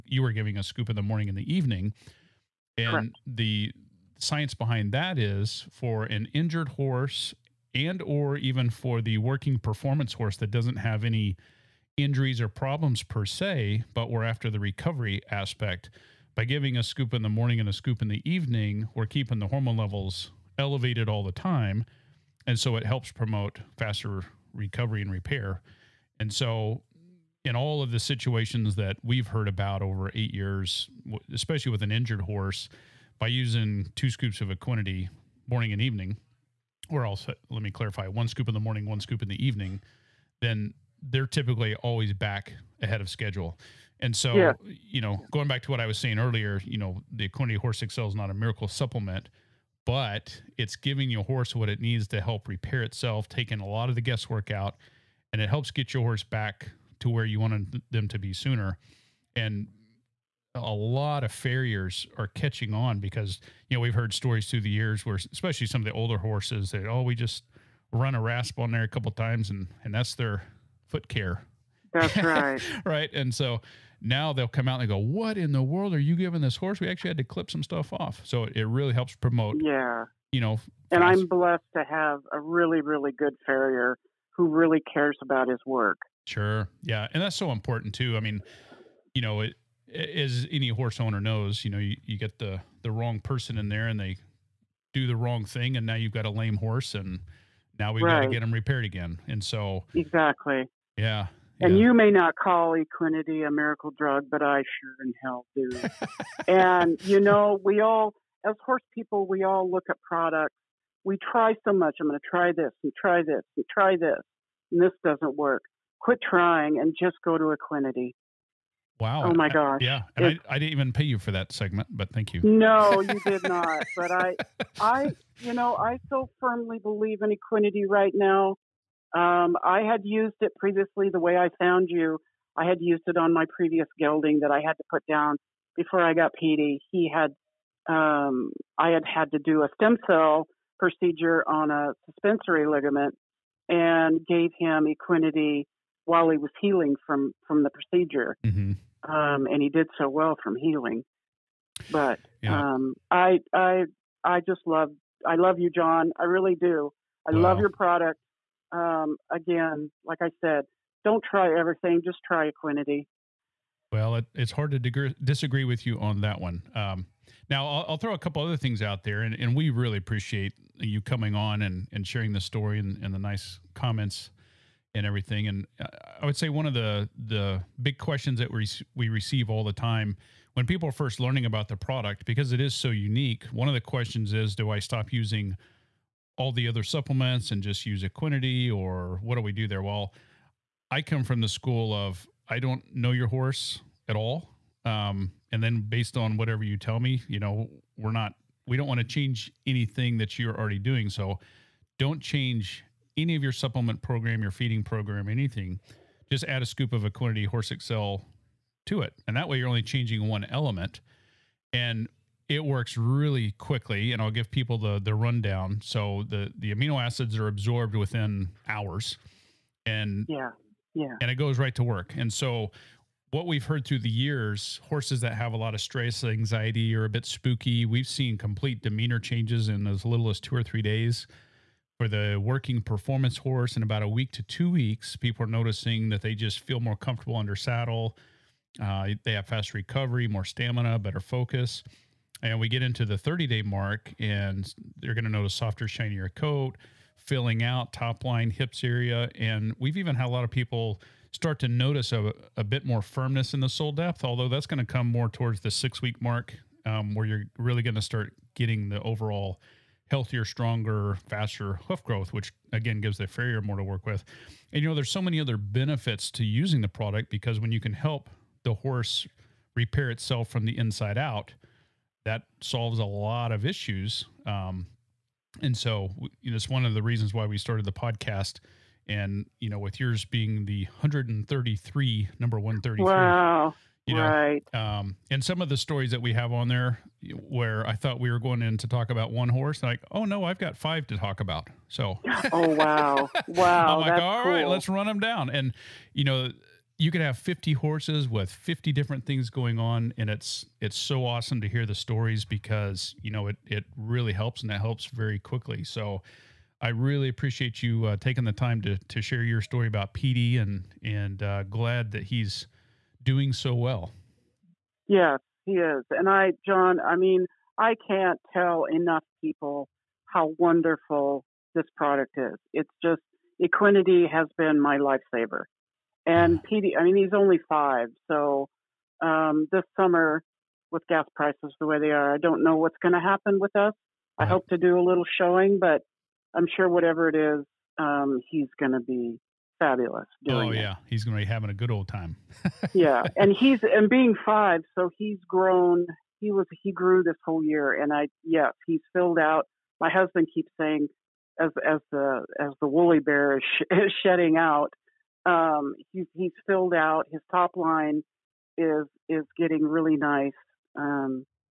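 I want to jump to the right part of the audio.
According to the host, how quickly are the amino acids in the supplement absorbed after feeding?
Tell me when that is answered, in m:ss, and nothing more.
3:37.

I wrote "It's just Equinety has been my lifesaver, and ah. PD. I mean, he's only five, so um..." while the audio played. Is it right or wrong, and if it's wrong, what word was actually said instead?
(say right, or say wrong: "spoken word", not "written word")
right.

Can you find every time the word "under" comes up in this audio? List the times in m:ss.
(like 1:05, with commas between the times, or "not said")
3:57.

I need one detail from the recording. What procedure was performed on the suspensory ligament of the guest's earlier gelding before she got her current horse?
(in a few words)
stem cell procedure.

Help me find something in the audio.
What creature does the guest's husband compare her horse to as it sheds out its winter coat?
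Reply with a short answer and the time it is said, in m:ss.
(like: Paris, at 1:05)
woolly bear, at 5:52.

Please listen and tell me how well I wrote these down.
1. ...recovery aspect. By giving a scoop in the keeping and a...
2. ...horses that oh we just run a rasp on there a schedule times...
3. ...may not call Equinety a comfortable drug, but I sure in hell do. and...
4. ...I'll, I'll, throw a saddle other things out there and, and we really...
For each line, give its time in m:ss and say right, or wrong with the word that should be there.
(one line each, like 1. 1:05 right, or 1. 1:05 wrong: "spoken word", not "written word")
1. 0:14 wrong: "morning", not "keeping"
2. 1:06 wrong: "couple", not "schedule"
3. 1:41 wrong: "miracle", not "comfortable"
4. 2:47 wrong: "couple", not "saddle".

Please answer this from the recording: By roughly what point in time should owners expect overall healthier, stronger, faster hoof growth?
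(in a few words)
6 weeks.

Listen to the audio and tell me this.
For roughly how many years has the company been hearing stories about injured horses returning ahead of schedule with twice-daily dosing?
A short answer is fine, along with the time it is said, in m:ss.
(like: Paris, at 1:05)
8 years, at 0:30.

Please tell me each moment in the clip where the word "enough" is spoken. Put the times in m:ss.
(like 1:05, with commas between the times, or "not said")
5:18.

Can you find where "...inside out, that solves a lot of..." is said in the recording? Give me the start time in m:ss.
4:30.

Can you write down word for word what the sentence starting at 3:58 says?
Uh, they have fast recovery, more stamina, better focus.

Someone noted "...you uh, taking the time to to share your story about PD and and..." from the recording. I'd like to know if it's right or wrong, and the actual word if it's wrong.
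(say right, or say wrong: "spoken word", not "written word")
right.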